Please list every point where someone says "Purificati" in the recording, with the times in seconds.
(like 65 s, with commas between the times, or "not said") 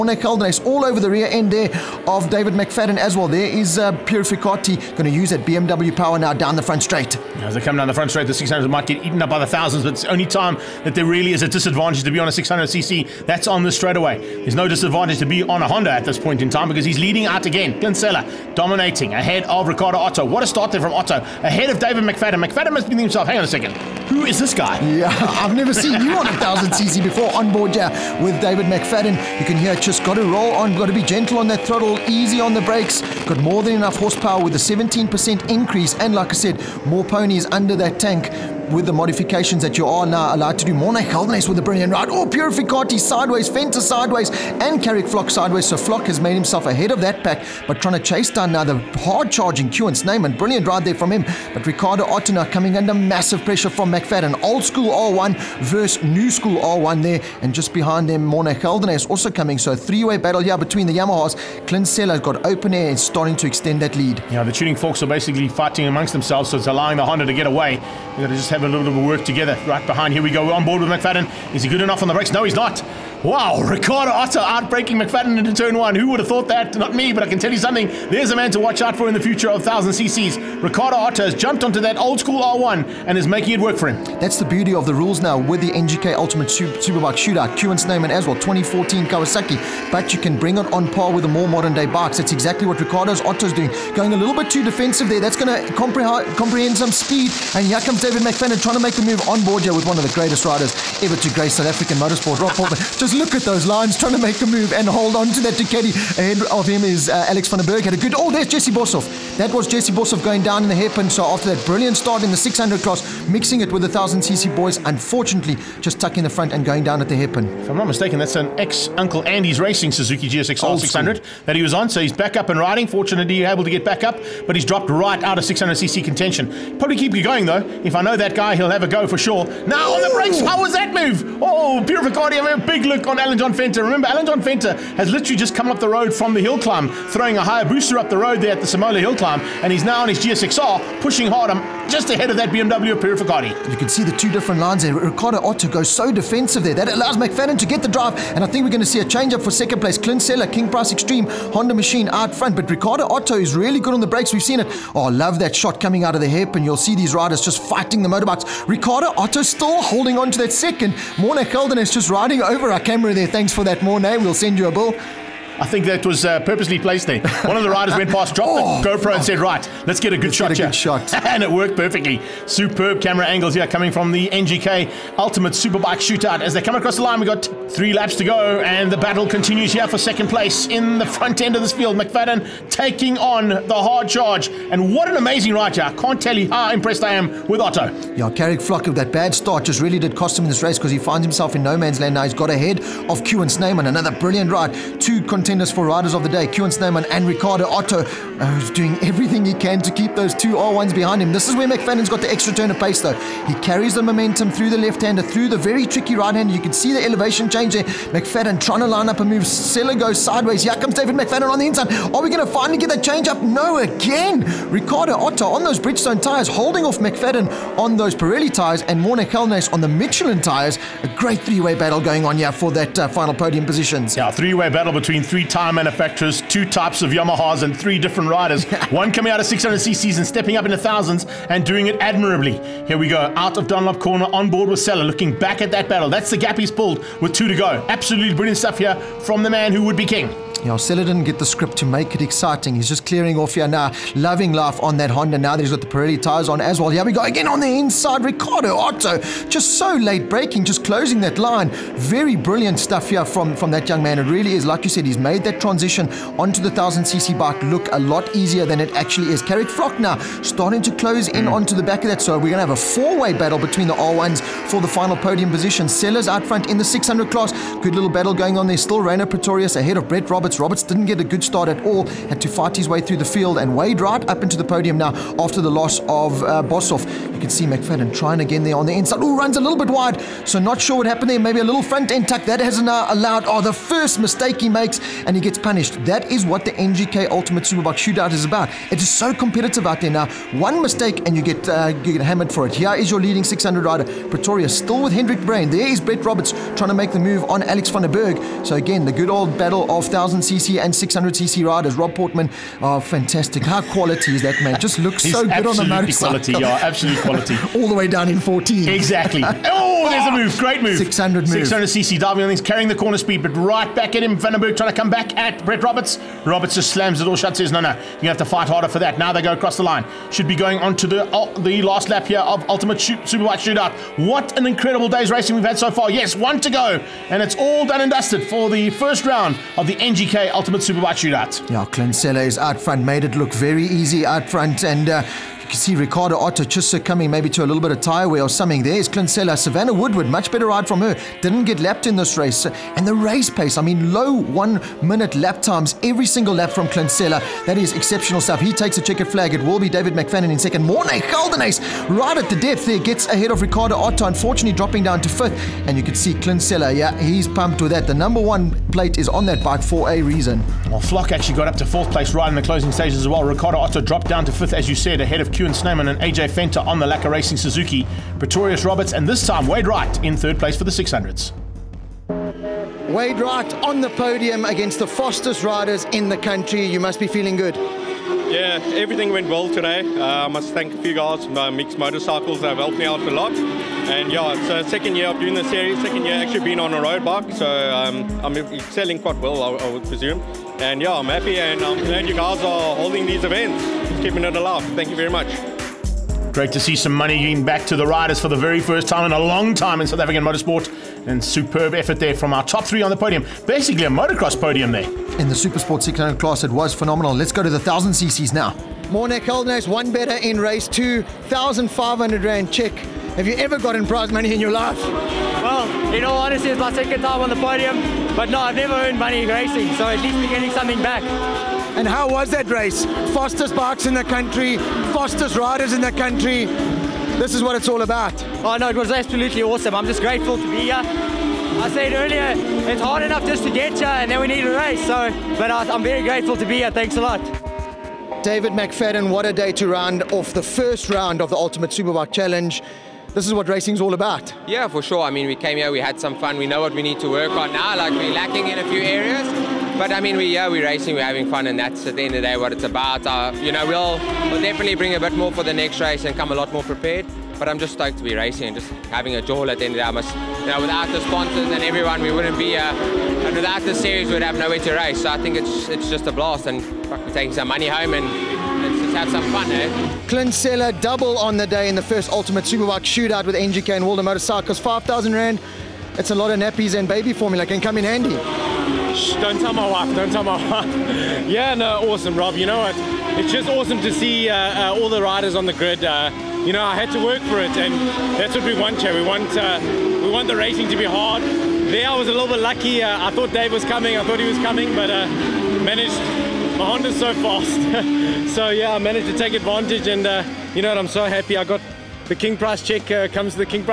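4 s, 42 s.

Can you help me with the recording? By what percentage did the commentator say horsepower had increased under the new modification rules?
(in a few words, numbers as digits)
17%.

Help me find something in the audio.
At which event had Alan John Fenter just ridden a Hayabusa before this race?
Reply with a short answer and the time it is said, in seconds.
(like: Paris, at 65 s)
Samola hill climb, at 138 s.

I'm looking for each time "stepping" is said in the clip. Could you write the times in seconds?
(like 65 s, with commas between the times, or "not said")
230 s.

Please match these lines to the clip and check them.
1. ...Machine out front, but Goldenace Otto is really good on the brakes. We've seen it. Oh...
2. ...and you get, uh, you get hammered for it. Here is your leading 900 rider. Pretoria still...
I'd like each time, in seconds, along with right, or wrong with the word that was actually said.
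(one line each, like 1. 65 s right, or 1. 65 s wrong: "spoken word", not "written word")
1. 151 s wrong: "Ricardo", not "Goldenace"
2. 291 s wrong: "600", not "900".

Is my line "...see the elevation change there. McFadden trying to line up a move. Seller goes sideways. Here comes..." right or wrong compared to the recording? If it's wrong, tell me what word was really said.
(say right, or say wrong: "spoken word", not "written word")
right.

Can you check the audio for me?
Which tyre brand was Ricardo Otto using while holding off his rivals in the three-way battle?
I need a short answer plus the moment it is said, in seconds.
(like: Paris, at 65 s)
Bridgestone, at 215 s.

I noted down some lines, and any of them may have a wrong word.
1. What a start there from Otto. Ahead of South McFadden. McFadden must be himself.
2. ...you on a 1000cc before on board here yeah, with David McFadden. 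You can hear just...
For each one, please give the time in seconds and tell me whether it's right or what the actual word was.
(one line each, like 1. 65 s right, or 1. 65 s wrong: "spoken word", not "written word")
1. 20 s wrong: "David", not "South"
2. 26 s right.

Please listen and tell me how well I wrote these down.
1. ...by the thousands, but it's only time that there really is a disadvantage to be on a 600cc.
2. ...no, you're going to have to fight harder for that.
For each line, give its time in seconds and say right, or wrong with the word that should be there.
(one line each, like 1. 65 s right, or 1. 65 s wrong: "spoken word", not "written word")
1. 9 s right
2. 317 s right.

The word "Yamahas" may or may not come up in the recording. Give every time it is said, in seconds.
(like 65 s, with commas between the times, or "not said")
60 s, 227 s.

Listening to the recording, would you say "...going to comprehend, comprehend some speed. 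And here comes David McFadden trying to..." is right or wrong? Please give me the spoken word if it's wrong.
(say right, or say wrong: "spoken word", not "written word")
right.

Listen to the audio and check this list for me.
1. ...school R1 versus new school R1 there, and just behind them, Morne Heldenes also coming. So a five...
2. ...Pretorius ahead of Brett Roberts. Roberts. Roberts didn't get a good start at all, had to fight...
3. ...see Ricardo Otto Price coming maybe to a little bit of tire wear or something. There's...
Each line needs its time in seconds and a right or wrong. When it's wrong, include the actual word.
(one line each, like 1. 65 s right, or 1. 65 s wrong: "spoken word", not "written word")
1. 54 s wrong: "three", not "five"
2. 269 s right
3. 335 s wrong: "Chissa", not "Price".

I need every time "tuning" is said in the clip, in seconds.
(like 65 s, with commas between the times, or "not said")
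64 s.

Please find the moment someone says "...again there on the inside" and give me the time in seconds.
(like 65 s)
278 s.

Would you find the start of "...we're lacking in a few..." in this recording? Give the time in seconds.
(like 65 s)
448 s.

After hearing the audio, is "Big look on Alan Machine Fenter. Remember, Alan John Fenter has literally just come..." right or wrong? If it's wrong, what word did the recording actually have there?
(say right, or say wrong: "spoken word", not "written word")
wrong: "John", not "Machine".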